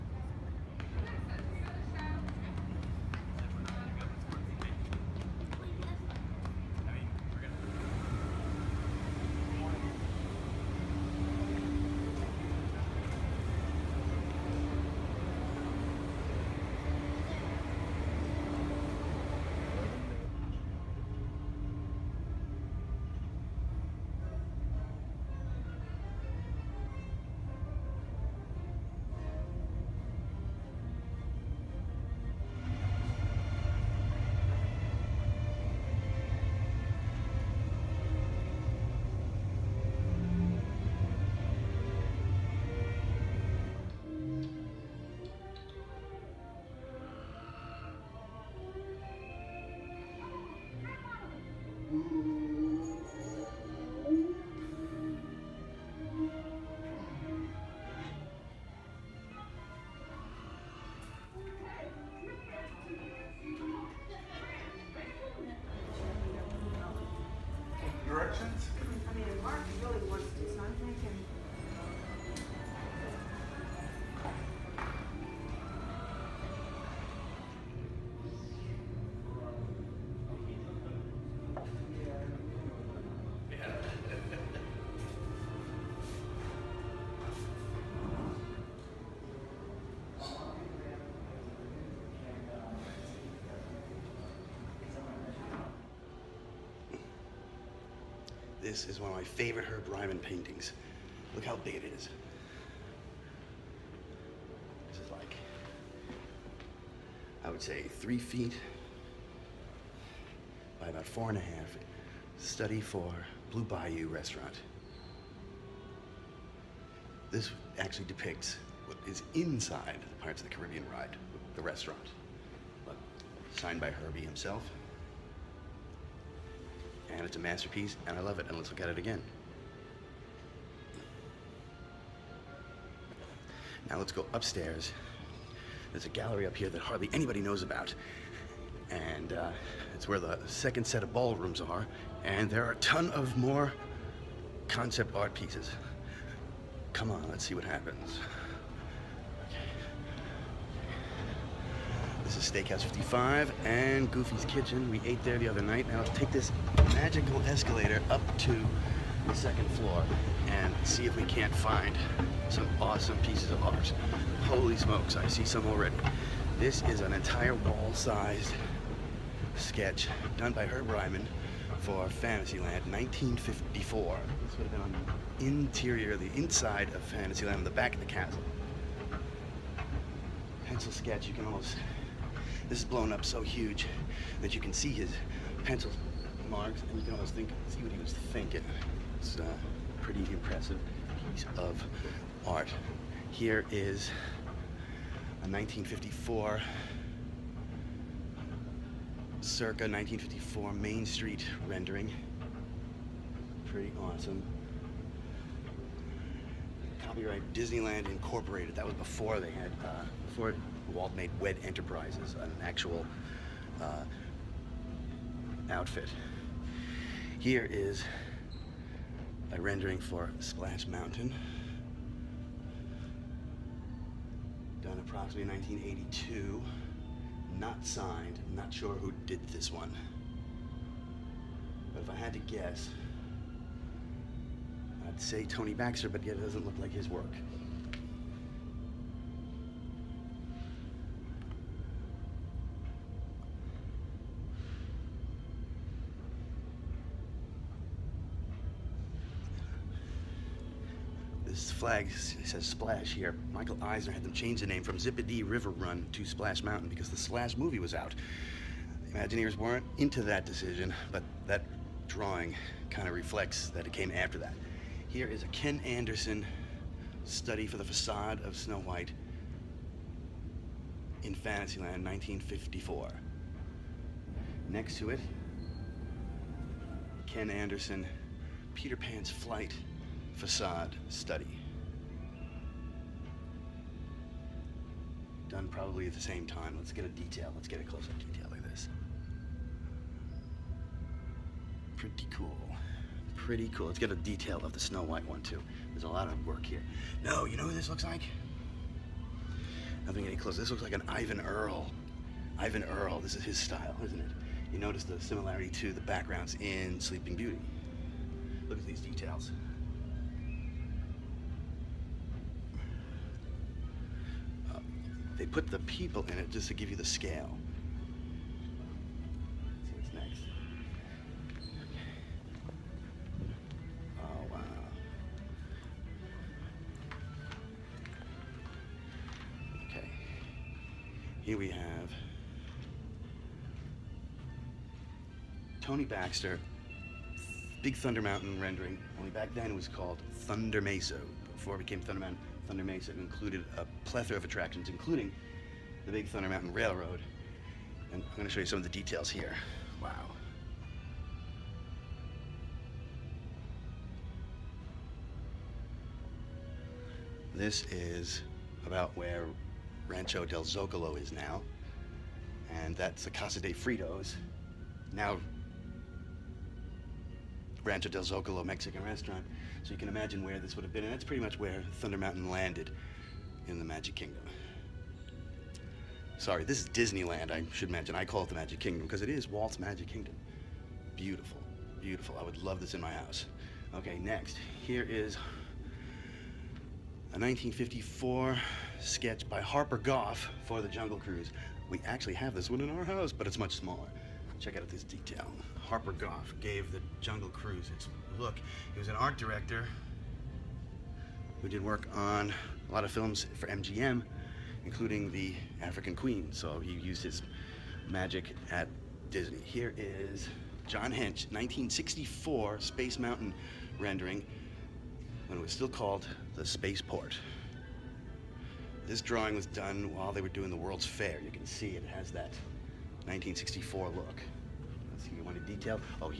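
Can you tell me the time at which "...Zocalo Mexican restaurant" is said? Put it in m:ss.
6:08.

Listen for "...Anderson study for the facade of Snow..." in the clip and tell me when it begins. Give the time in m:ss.
4:25.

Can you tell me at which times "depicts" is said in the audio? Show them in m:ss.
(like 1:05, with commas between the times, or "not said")
1:58.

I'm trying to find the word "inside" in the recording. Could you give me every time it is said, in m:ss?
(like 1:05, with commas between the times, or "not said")
1:59, 2:56.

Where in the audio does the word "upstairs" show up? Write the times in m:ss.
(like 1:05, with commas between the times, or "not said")
2:14.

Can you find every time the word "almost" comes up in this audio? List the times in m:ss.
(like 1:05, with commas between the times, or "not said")
3:01, 3:07.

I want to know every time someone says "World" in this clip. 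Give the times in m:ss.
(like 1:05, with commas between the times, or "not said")
7:00.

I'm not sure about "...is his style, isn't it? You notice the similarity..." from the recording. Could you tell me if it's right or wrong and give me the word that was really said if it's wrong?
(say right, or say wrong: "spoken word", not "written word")
right.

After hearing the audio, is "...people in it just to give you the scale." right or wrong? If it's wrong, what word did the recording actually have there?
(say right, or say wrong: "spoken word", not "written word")
right.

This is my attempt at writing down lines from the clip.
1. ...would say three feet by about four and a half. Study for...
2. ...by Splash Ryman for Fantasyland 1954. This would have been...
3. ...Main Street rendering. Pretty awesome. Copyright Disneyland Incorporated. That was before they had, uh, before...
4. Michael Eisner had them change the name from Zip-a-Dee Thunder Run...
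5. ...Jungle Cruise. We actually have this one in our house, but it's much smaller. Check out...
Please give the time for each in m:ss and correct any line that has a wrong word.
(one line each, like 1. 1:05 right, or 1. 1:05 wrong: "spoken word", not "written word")
1. 1:47 right
2. 2:50 wrong: "Herb", not "Splash"
3. 3:20 right
4. 4:13 wrong: "River", not "Thunder"
5. 6:30 right.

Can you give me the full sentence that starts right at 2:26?
Come on, let's see what happens.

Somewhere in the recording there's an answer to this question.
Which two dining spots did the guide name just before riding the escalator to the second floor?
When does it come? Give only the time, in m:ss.
2:32.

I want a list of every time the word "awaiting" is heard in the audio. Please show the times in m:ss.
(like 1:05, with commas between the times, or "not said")
not said.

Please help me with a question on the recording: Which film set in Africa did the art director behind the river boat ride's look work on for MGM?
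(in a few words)
The African Queen.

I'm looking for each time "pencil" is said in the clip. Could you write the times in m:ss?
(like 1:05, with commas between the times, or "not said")
3:00, 3:05.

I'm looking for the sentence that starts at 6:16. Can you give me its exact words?
Sorry, this is Disneyland, I should mention.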